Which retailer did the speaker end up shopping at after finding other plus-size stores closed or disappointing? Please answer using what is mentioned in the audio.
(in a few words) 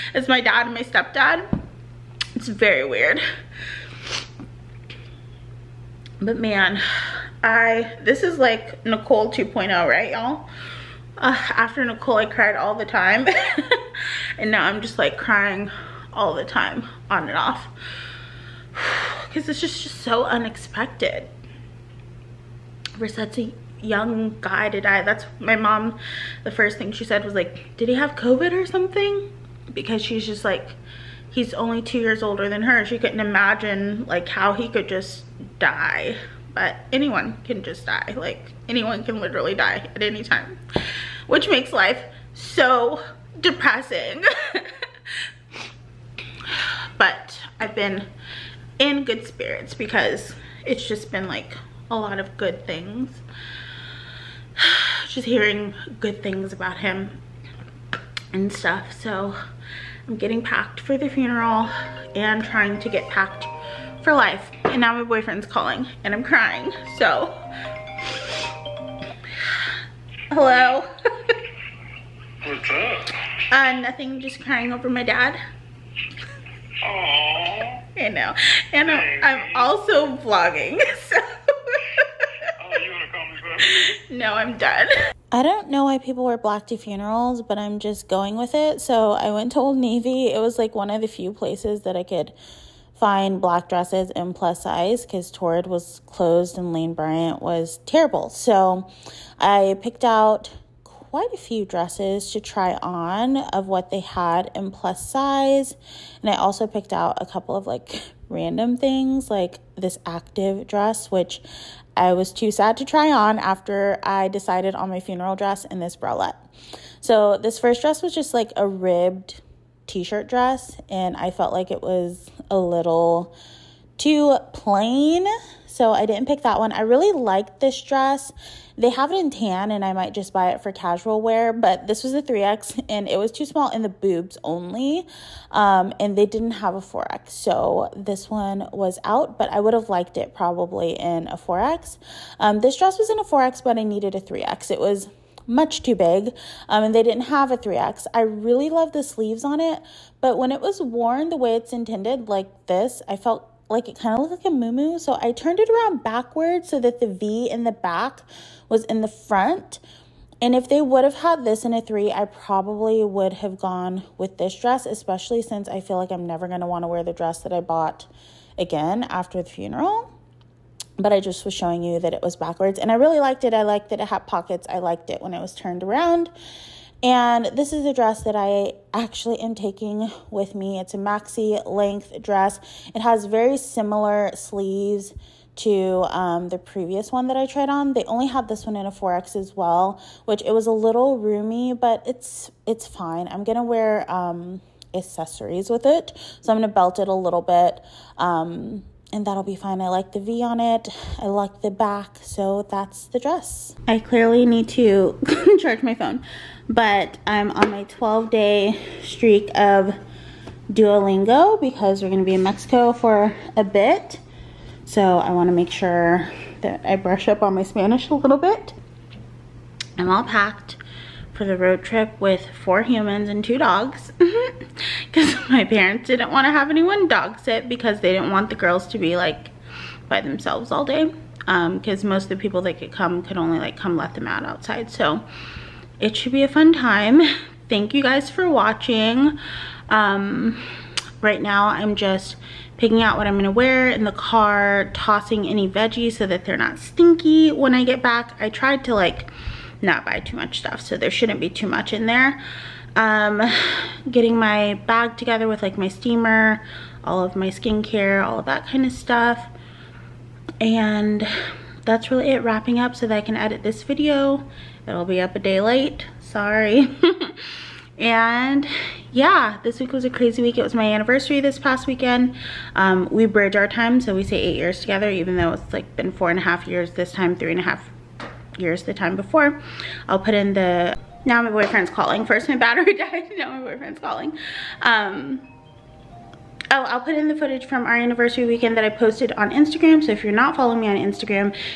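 Old Navy.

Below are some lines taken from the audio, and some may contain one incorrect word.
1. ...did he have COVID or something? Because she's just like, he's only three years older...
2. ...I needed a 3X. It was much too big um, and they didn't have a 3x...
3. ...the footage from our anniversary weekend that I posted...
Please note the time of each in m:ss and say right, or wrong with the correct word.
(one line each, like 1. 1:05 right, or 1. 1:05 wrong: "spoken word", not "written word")
1. 0:27 wrong: "two", not "three"
2. 2:23 right
3. 4:47 right.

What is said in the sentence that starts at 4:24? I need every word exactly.
It'll be up a day late, sorry.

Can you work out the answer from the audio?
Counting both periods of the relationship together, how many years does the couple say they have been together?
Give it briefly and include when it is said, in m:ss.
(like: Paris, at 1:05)
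8, at 4:34.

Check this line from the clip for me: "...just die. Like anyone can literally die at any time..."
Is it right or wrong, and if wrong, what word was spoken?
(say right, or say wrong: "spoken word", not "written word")
right.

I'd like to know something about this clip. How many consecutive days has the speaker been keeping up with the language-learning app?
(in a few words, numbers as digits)
12.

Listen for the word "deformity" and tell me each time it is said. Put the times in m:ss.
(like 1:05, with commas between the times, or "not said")
not said.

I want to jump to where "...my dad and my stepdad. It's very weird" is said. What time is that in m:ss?
0:00.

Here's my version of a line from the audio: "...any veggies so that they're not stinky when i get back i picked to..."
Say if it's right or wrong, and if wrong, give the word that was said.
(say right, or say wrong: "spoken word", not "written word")
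wrong: "tried", not "picked".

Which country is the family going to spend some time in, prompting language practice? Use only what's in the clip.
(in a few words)
Mexico.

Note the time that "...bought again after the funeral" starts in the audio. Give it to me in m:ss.
2:47.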